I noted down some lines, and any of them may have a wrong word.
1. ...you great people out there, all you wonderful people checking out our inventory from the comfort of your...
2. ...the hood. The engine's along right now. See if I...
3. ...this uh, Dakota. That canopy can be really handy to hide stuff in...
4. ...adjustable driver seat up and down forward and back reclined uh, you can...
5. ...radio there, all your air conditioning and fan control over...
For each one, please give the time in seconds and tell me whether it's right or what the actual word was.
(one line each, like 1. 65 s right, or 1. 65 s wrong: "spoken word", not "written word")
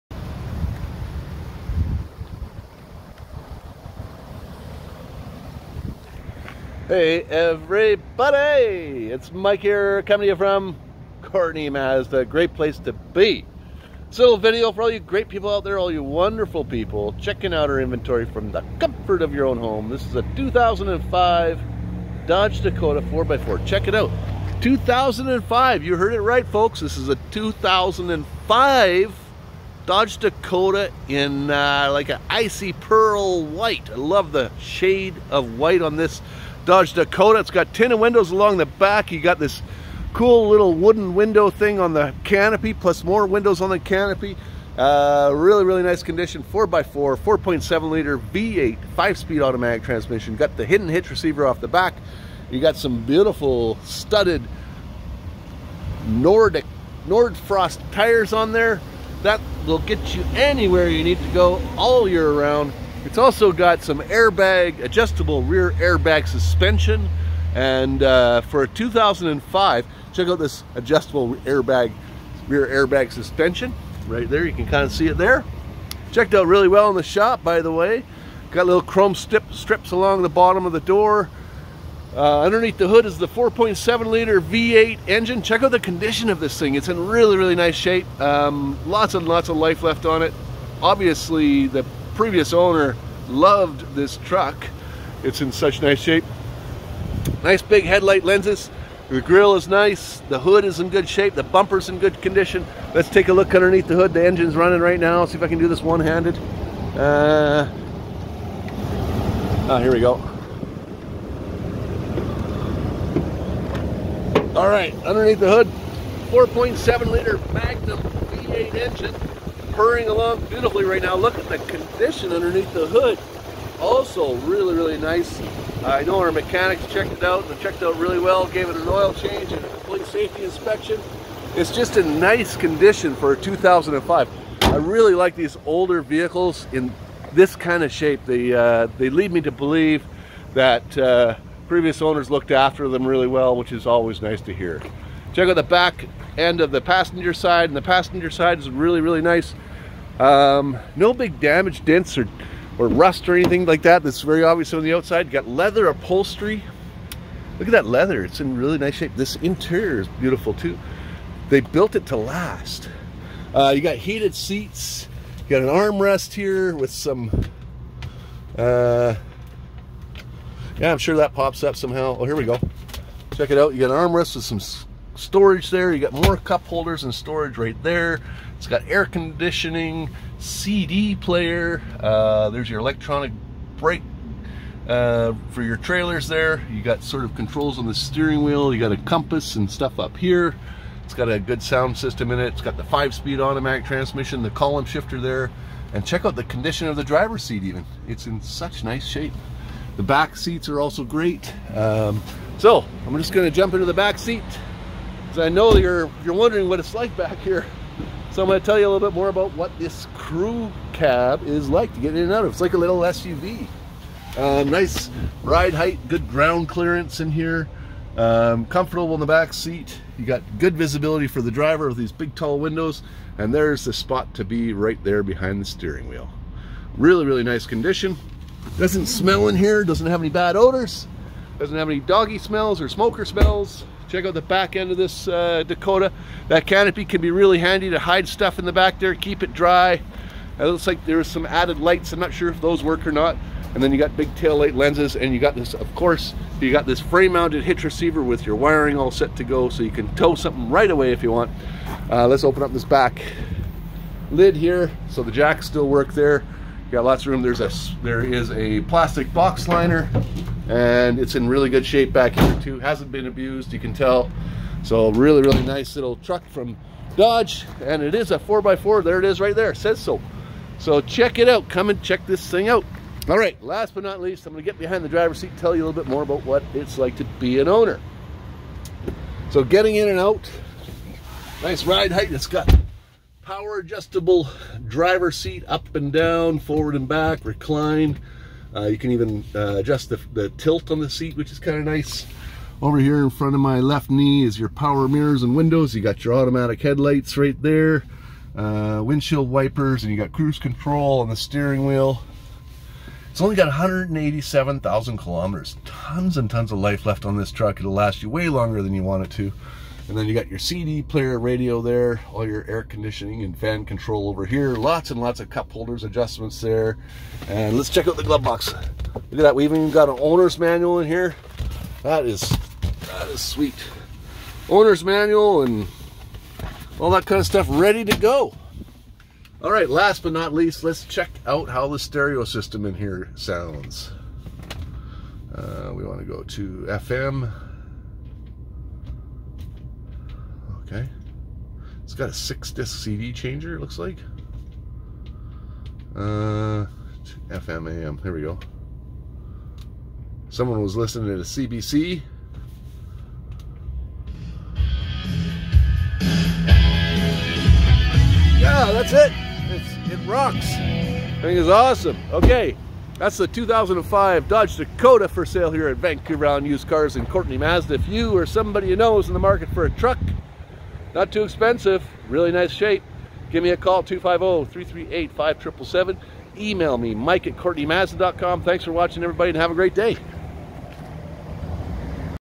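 1. 14 s right
2. 103 s wrong: "running", not "along"
3. 234 s right
4. 283 s right
5. 311 s right.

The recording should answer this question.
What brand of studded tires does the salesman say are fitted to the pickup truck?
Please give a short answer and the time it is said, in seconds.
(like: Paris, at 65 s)
Nordic Nordfrost, at 56 s.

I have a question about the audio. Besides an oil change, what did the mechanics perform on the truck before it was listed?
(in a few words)
Complete safety inspection.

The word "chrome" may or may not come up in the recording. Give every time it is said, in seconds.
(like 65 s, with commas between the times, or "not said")
78 s.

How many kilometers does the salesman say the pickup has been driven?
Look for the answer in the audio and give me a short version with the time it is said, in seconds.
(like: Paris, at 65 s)
187,000 kilometers, at 303 s.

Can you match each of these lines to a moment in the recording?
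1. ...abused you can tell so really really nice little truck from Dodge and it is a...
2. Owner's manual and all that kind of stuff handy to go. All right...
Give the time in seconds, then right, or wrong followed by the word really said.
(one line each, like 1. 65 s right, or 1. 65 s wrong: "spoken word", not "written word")
1. 263 s right
2. 324 s wrong: "ready", not "handy".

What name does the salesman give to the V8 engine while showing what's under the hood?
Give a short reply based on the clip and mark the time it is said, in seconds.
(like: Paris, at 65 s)
Magnum, at 117 s.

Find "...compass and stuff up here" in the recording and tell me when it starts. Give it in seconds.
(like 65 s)
188 s.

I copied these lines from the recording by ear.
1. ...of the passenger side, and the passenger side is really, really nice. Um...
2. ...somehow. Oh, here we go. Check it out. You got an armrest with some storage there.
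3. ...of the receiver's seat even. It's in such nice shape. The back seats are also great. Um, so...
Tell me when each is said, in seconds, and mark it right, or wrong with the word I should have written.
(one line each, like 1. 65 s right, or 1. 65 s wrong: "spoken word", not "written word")
1. 146 s right
2. 171 s right
3. 196 s wrong: "driver", not "receiver".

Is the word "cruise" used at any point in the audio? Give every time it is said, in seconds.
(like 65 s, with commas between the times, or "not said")
300 s.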